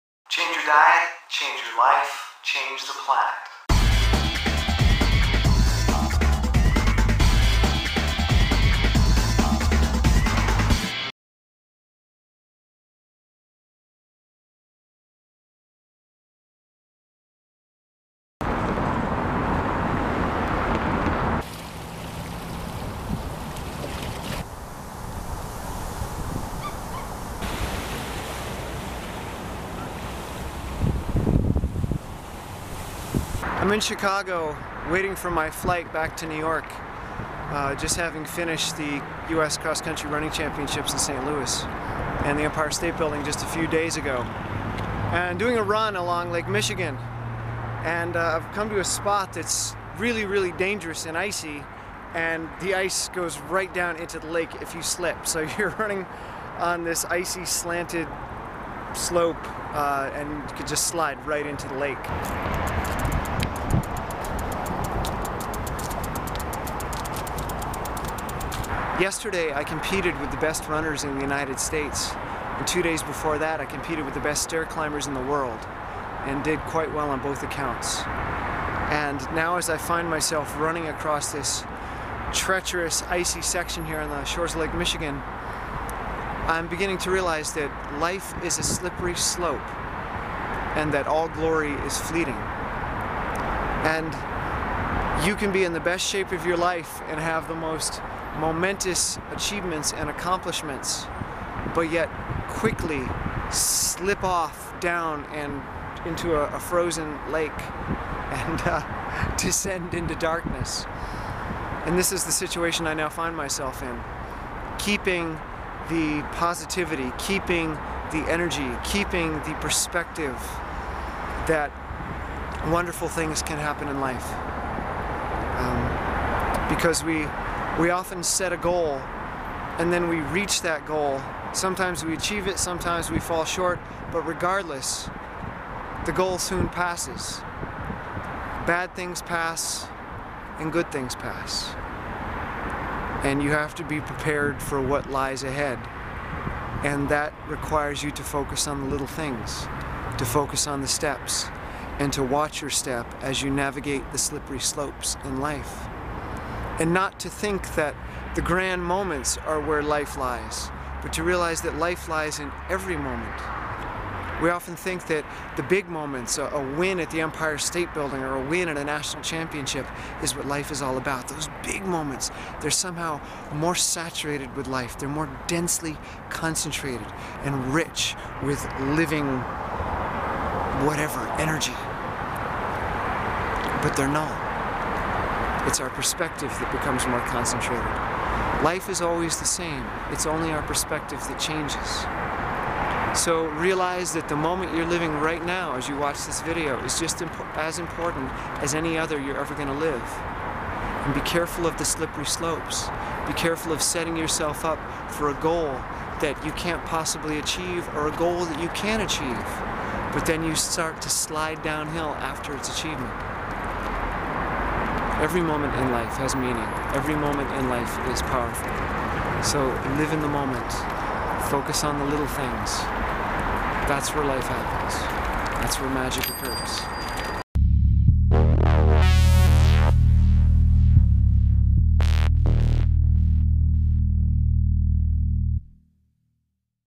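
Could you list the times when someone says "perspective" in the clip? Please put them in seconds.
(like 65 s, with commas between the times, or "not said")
119 s, 185 s, 190 s.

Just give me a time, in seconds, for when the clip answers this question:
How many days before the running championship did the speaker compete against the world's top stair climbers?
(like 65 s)
72 s.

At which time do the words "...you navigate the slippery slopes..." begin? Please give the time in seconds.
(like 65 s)
153 s.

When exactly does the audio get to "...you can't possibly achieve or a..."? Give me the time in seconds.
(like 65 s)
206 s.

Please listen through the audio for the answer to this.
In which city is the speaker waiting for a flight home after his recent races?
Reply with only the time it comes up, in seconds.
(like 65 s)
33 s.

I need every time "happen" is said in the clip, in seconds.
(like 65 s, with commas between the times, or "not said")
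123 s, 224 s.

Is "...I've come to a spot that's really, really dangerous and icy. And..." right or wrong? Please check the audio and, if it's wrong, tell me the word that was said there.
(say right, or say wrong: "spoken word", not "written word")
right.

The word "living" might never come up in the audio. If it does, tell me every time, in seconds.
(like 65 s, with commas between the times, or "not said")
178 s, 194 s.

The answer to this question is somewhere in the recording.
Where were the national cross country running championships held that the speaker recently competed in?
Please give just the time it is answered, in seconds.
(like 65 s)
40 s.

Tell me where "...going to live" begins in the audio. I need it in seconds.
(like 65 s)
199 s.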